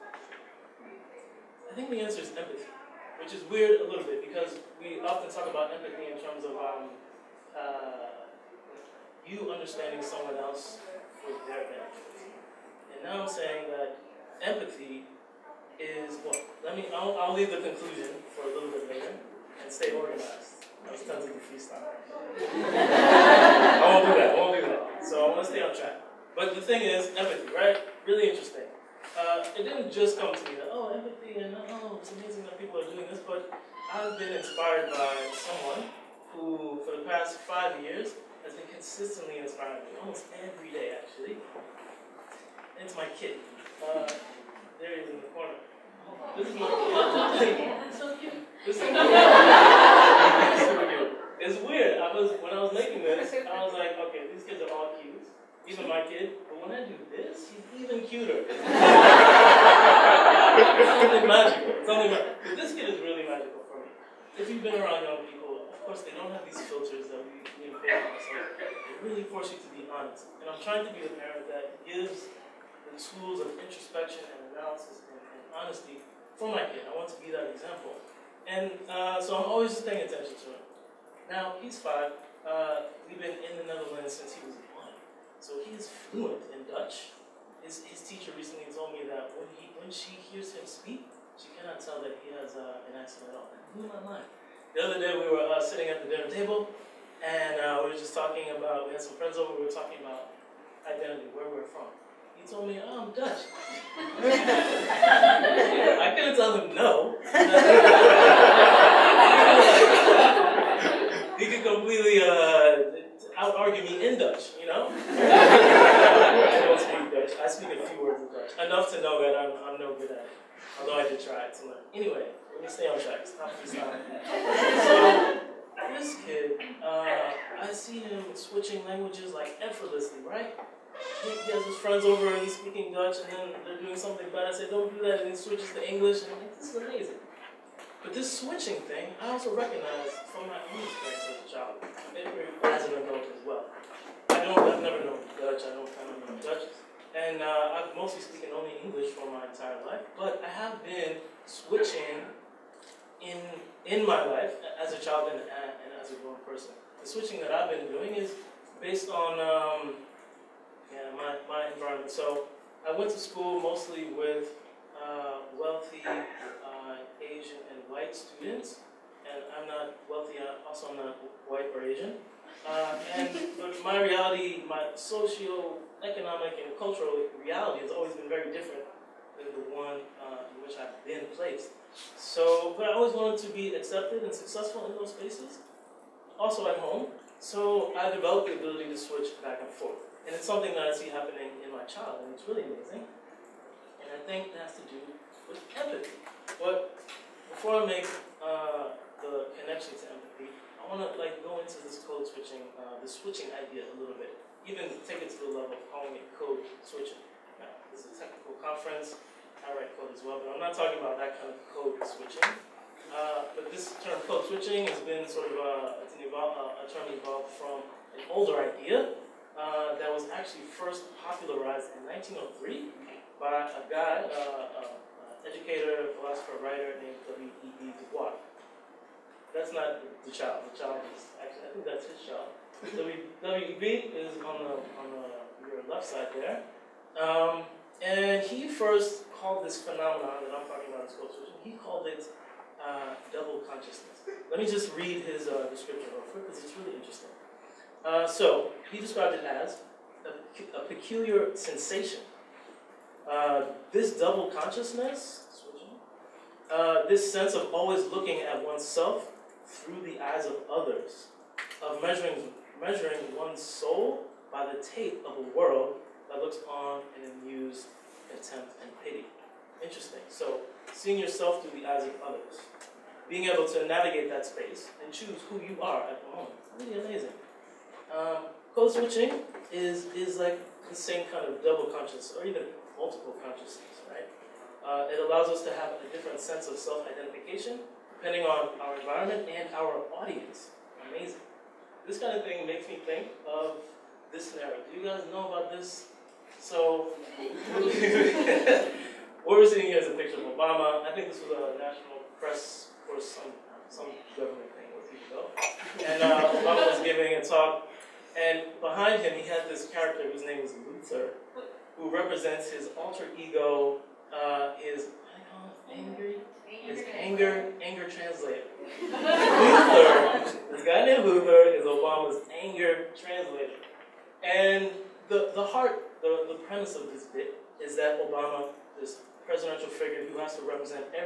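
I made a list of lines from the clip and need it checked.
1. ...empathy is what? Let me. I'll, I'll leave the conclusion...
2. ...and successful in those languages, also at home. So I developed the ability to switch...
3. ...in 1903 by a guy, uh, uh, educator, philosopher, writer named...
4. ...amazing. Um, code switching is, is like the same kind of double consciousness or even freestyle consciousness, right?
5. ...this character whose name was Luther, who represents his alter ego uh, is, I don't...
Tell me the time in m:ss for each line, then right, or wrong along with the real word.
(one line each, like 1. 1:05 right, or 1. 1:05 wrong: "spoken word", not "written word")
1. 0:14 right
2. 3:04 wrong: "spaces", not "languages"
3. 3:41 right
4. 4:37 wrong: "multiple", not "freestyle"
5. 5:09 right.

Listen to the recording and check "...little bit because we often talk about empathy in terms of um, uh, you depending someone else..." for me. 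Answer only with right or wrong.
wrong.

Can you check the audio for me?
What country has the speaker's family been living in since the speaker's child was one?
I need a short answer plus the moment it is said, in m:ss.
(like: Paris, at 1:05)
the Netherlands, at 1:23.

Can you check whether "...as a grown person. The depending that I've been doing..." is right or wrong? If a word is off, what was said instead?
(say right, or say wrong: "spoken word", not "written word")
wrong: "switching", not "depending".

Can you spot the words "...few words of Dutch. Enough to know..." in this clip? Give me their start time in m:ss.
1:57.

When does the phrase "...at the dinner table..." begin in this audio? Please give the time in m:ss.
1:35.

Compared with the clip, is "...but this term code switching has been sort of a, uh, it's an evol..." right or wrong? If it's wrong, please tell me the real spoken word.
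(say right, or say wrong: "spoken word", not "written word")
right.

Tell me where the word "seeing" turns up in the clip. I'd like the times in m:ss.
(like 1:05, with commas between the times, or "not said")
4:30, 4:59.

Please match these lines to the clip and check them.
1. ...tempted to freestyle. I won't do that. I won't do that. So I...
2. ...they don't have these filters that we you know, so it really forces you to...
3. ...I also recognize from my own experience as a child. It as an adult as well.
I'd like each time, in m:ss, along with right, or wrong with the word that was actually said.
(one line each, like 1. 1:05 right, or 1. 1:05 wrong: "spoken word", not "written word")
1. 0:21 right
2. 1:06 right
3. 2:19 right.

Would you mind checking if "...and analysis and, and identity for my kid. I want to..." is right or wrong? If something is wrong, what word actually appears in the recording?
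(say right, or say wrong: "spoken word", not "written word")
wrong: "honesty", not "identity".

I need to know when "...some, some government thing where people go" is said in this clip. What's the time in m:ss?
5:03.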